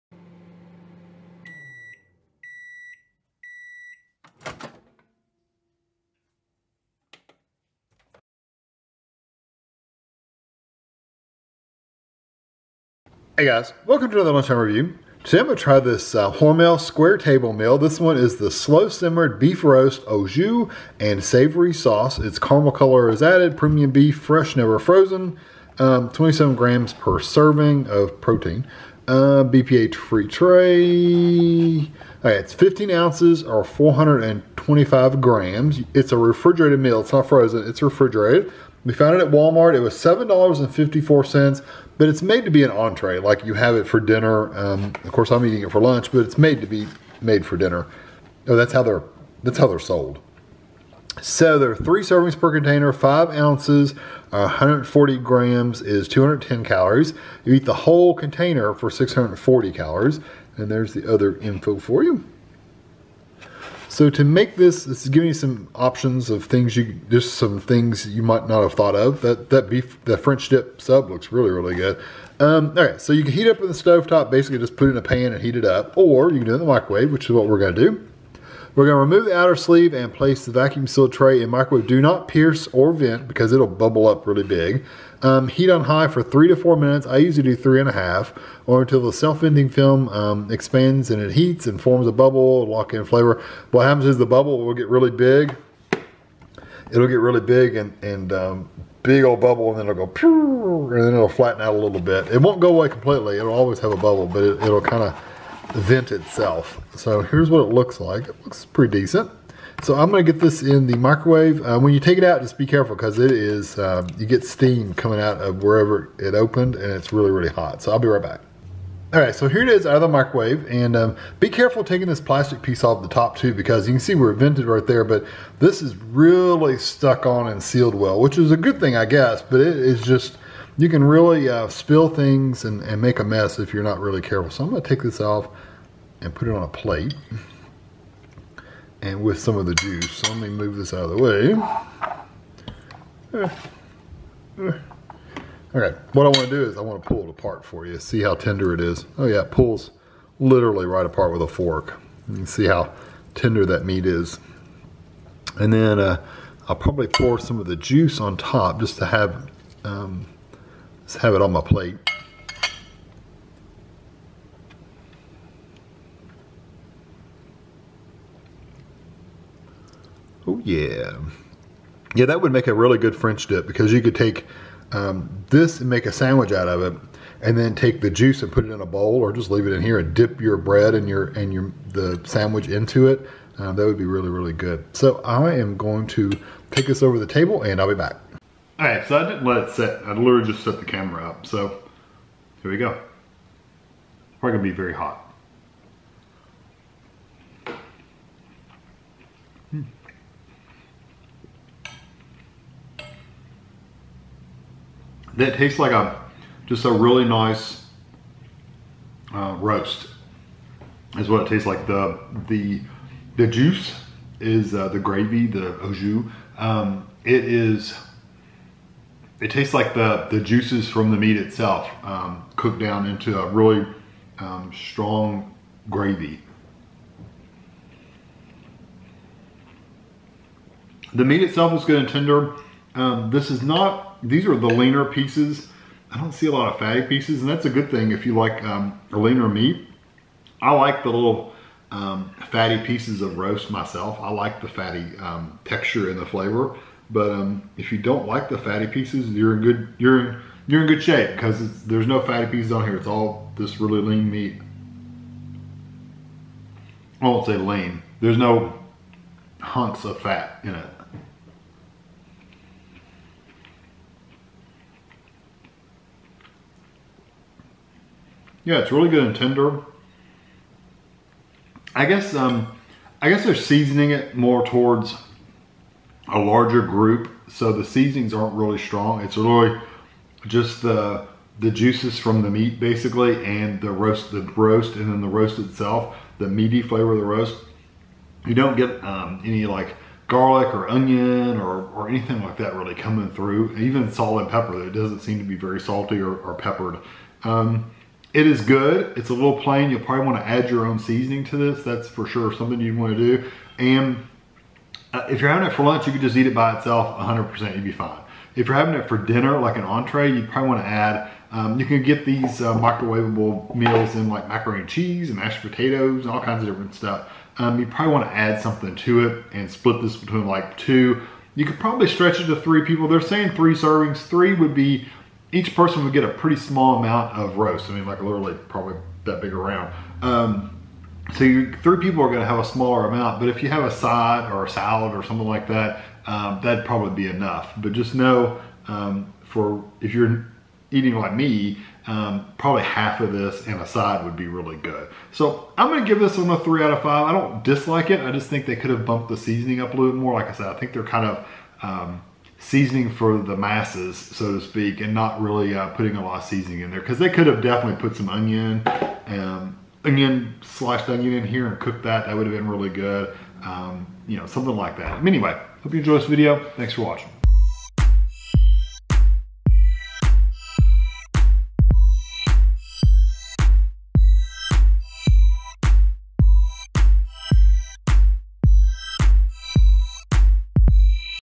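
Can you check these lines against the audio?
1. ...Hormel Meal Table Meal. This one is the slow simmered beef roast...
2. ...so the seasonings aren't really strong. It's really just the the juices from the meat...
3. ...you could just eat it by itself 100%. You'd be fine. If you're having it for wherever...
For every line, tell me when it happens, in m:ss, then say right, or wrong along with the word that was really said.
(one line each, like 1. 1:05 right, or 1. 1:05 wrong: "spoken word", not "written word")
1. 0:16 wrong: "Square", not "Meal"
2. 4:37 right
3. 5:06 wrong: "dinner", not "wherever".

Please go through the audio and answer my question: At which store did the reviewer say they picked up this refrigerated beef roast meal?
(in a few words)
Walmart.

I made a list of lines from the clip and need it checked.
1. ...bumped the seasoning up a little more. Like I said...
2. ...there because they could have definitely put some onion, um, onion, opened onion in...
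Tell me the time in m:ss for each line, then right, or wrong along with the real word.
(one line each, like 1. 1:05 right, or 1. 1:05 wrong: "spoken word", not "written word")
1. 5:49 right
2. 5:56 wrong: "sliced", not "opened".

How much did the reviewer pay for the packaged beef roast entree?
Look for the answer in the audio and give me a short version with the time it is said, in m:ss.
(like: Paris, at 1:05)
$7.54, at 0:39.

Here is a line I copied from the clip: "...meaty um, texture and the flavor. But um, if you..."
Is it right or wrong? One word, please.
wrong.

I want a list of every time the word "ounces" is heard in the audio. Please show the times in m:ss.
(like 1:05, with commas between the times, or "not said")
0:32, 0:53.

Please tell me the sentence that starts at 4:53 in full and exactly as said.
Even salt and pepper, it doesn't seem to be very salty or, or peppered.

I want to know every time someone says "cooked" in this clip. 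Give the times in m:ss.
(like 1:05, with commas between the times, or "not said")
3:42, 6:01.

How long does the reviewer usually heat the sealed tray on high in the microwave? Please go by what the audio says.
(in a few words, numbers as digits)
3 and a half minutes.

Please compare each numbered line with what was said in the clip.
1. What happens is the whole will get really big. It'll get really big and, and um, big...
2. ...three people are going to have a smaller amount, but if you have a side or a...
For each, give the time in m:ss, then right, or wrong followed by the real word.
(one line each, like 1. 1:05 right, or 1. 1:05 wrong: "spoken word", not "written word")
1. 1:33 wrong: "bubble", not "whole"
2. 5:31 right.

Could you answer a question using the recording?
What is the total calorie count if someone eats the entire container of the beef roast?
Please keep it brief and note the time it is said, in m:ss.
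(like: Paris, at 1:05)
640 calories, at 0:58.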